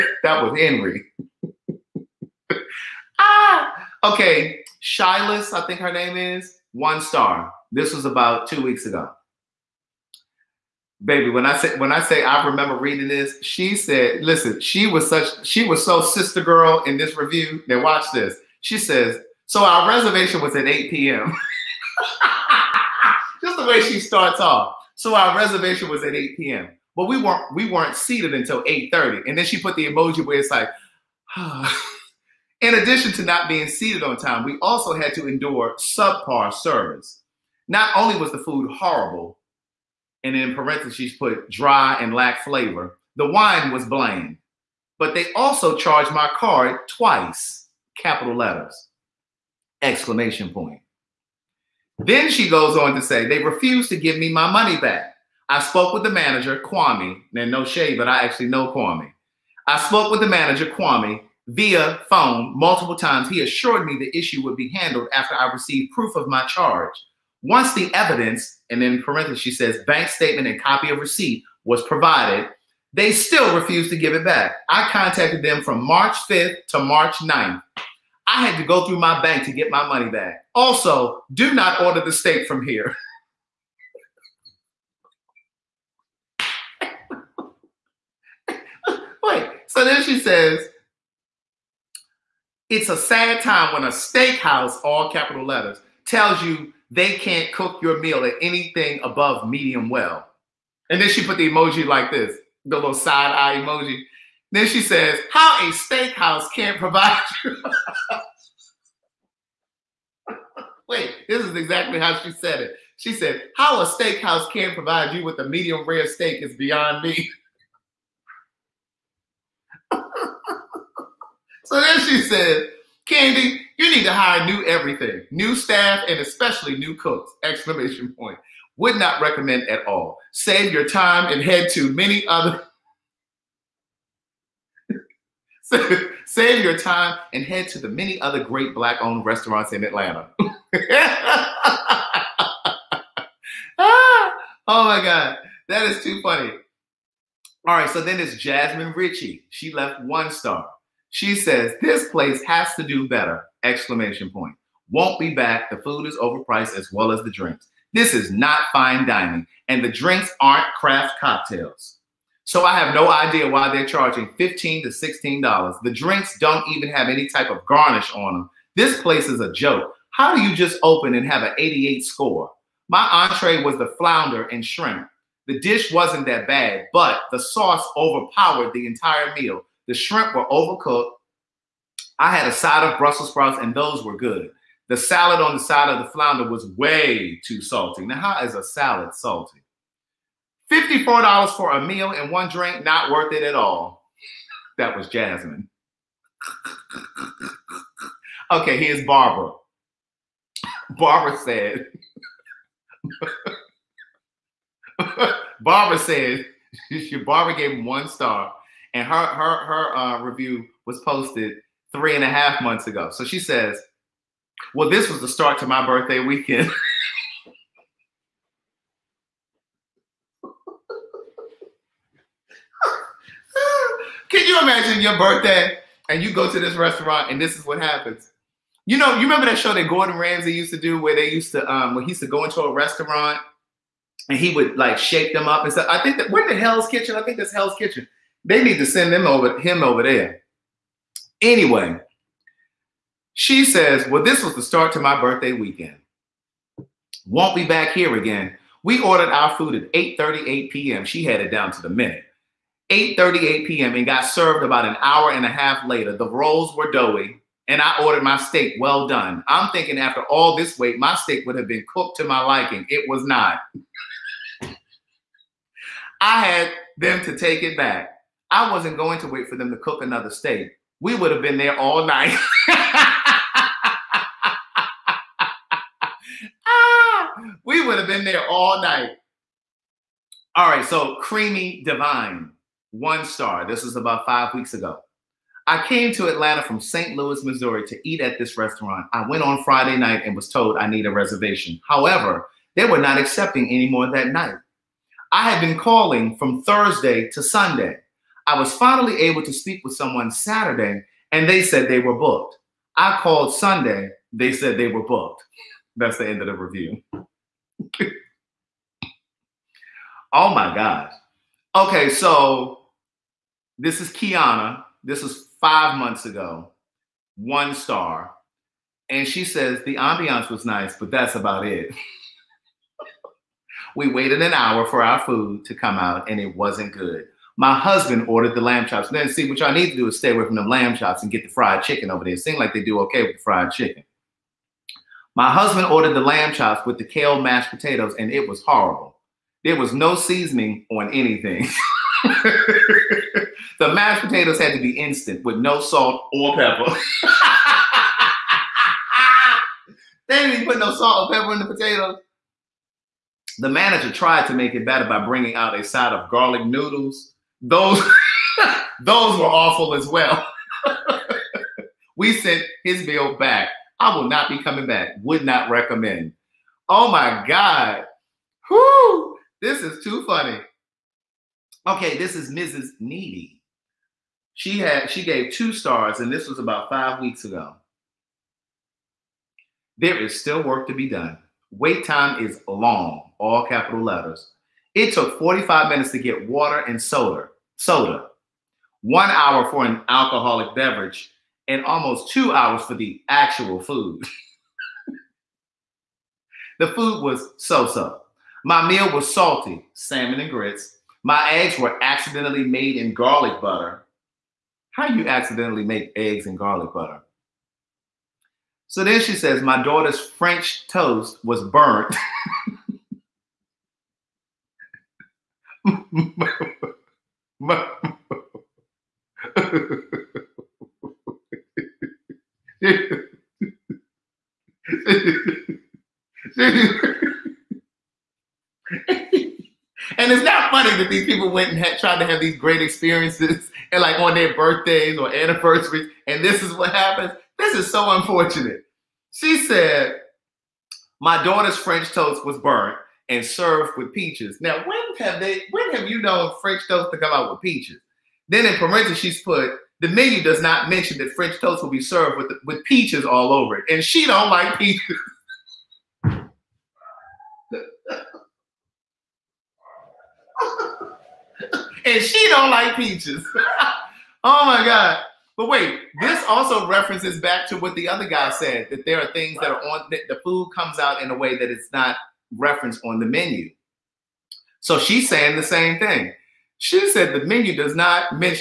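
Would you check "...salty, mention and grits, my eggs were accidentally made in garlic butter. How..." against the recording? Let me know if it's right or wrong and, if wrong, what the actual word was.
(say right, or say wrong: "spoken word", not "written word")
wrong: "salmon", not "mention".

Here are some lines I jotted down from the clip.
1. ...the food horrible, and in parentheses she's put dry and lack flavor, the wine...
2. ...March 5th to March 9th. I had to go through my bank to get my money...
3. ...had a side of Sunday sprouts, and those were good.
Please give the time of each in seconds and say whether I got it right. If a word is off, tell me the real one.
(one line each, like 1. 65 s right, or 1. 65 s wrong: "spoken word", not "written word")
1. 38 s right
2. 75 s right
3. 182 s wrong: "Brussels", not "Sunday".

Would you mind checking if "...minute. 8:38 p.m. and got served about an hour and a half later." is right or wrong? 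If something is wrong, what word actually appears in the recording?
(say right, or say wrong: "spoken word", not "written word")
right.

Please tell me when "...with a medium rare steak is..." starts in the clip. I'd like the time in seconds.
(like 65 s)
115 s.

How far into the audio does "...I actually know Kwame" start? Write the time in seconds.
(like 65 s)
58 s.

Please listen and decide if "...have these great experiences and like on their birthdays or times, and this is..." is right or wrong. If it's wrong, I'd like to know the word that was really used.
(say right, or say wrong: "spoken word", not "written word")
wrong: "anniversaries", not "times".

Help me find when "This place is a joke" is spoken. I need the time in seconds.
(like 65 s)
168 s.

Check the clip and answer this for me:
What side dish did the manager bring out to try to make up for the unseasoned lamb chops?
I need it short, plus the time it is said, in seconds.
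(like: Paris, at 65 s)
garlic noodles, at 356 s.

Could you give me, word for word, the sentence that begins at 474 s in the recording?
So she's saying the same thing.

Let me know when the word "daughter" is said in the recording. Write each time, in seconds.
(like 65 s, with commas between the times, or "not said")
409 s, 441 s.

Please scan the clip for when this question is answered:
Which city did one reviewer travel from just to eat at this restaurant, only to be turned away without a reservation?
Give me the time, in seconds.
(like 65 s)
286 s.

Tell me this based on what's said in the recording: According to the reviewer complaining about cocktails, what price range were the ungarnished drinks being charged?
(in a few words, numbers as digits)
$15 to $16.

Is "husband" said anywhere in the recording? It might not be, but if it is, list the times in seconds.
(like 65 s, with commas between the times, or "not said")
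327 s, 335 s.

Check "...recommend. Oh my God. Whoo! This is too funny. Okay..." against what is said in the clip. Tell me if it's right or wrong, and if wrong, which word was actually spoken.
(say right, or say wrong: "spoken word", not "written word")
right.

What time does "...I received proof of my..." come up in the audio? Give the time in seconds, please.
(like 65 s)
65 s.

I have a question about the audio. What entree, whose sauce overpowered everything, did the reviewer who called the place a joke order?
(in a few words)
flounder and shrimp.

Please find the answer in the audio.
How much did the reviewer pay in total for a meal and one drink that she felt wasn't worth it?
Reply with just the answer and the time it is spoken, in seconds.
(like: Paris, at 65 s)
$54, at 190 s.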